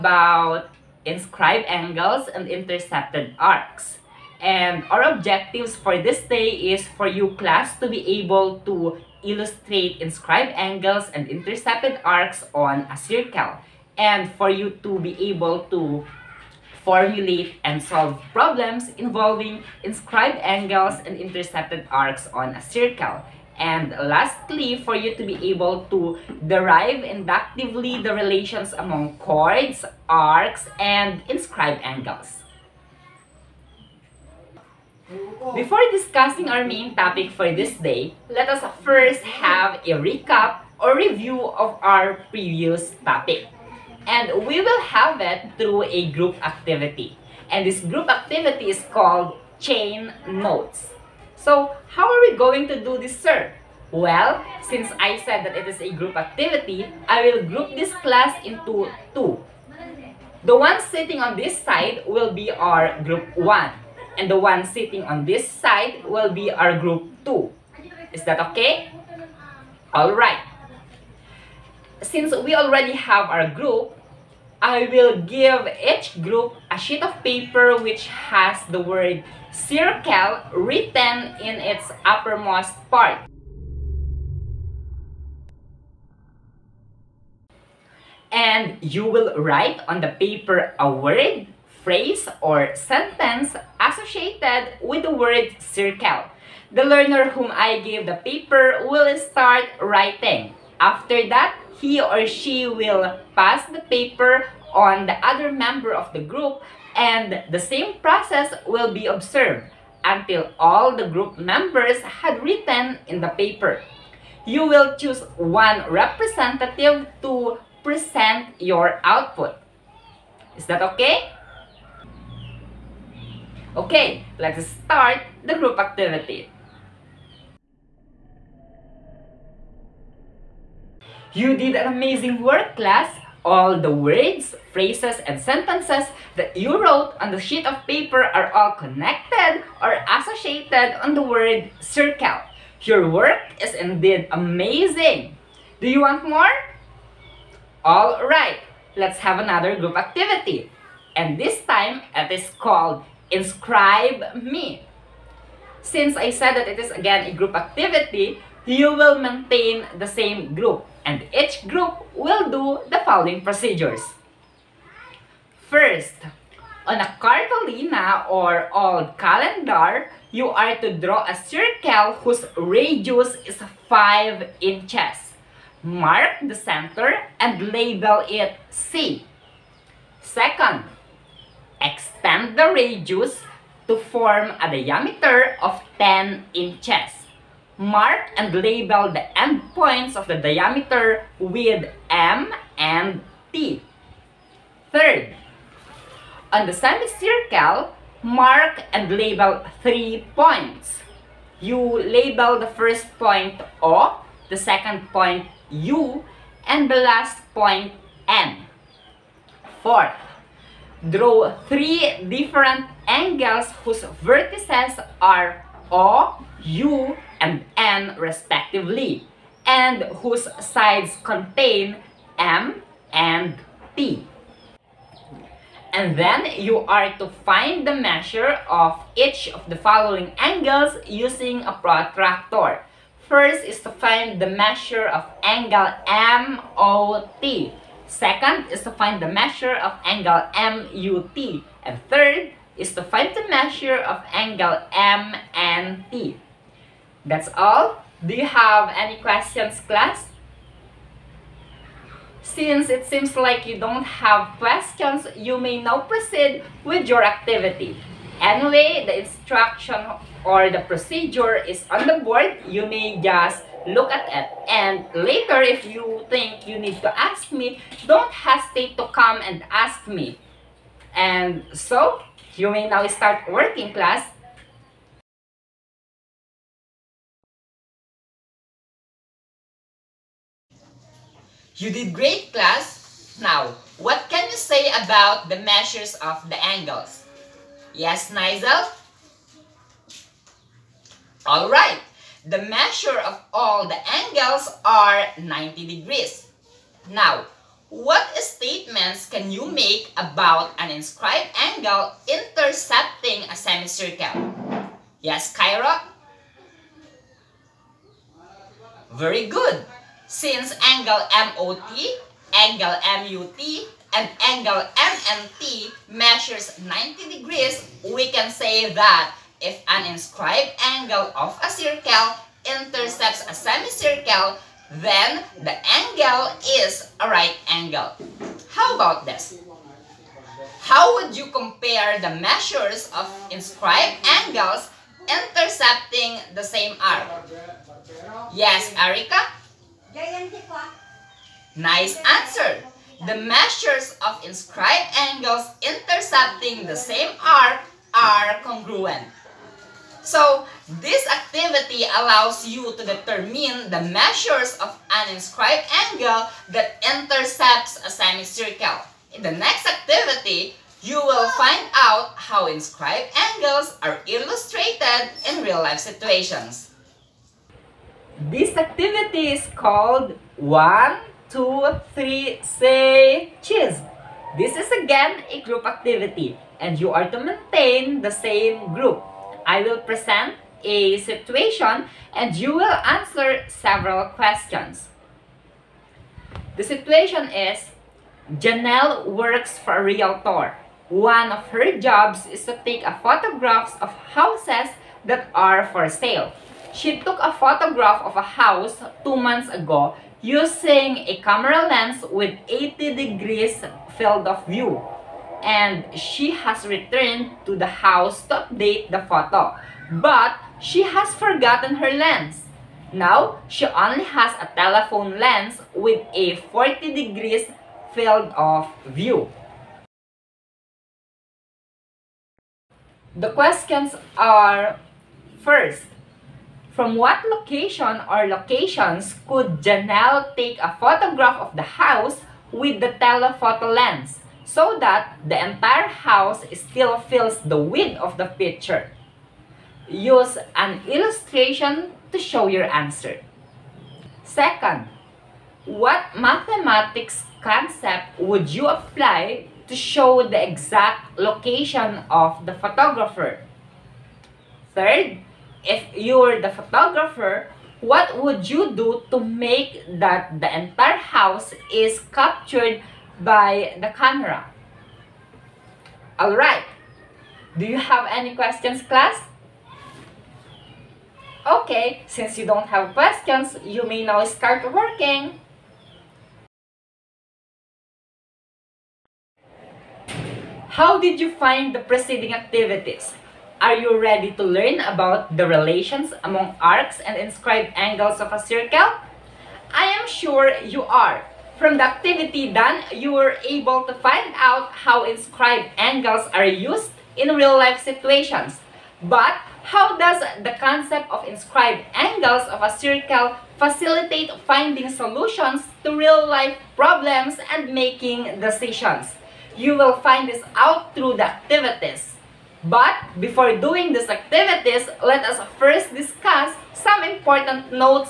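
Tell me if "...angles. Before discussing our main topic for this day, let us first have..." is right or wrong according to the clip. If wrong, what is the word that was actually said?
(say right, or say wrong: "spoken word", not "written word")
right.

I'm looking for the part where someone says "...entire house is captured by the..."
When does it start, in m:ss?
7:40.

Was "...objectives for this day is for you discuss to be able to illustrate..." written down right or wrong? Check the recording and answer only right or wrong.
wrong.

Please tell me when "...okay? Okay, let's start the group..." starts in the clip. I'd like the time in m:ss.
2:00.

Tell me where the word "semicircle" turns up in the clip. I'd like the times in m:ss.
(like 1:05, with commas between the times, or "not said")
3:16, 5:03, 5:23, 5:58.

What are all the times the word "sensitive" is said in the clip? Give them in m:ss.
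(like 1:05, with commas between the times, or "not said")
not said.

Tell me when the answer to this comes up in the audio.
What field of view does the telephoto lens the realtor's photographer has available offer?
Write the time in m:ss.
6:56.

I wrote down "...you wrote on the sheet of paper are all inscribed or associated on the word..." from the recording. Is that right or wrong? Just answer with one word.
wrong.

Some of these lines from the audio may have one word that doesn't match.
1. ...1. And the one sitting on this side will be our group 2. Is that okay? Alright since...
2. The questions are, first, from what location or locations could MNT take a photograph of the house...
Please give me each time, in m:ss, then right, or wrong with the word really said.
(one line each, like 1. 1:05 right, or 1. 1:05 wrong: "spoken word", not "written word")
1. 1:03 right
2. 7:03 wrong: "Janelle", not "MNT".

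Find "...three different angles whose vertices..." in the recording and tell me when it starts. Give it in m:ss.
3:31.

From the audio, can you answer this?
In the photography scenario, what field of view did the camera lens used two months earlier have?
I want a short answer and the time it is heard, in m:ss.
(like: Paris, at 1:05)
80 degrees, at 6:42.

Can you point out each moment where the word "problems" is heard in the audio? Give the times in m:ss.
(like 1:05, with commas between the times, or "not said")
0:18, 8:26.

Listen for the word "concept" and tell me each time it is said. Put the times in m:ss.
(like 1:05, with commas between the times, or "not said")
7:27, 8:20.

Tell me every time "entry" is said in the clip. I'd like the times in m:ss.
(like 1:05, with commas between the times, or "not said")
not said.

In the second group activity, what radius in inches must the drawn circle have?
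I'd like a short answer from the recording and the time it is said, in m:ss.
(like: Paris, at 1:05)
5 inches, at 2:53.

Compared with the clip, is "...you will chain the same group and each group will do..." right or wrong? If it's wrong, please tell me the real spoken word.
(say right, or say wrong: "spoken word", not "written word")
wrong: "maintain", not "chain".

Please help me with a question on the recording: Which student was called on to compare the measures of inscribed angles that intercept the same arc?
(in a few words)
Erica.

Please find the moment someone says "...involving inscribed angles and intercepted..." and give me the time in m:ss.
0:18.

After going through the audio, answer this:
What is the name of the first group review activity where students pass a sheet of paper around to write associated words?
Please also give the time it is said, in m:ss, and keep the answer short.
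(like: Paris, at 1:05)
Chain notes, at 0:49.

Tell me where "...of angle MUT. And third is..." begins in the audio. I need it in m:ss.
3:59.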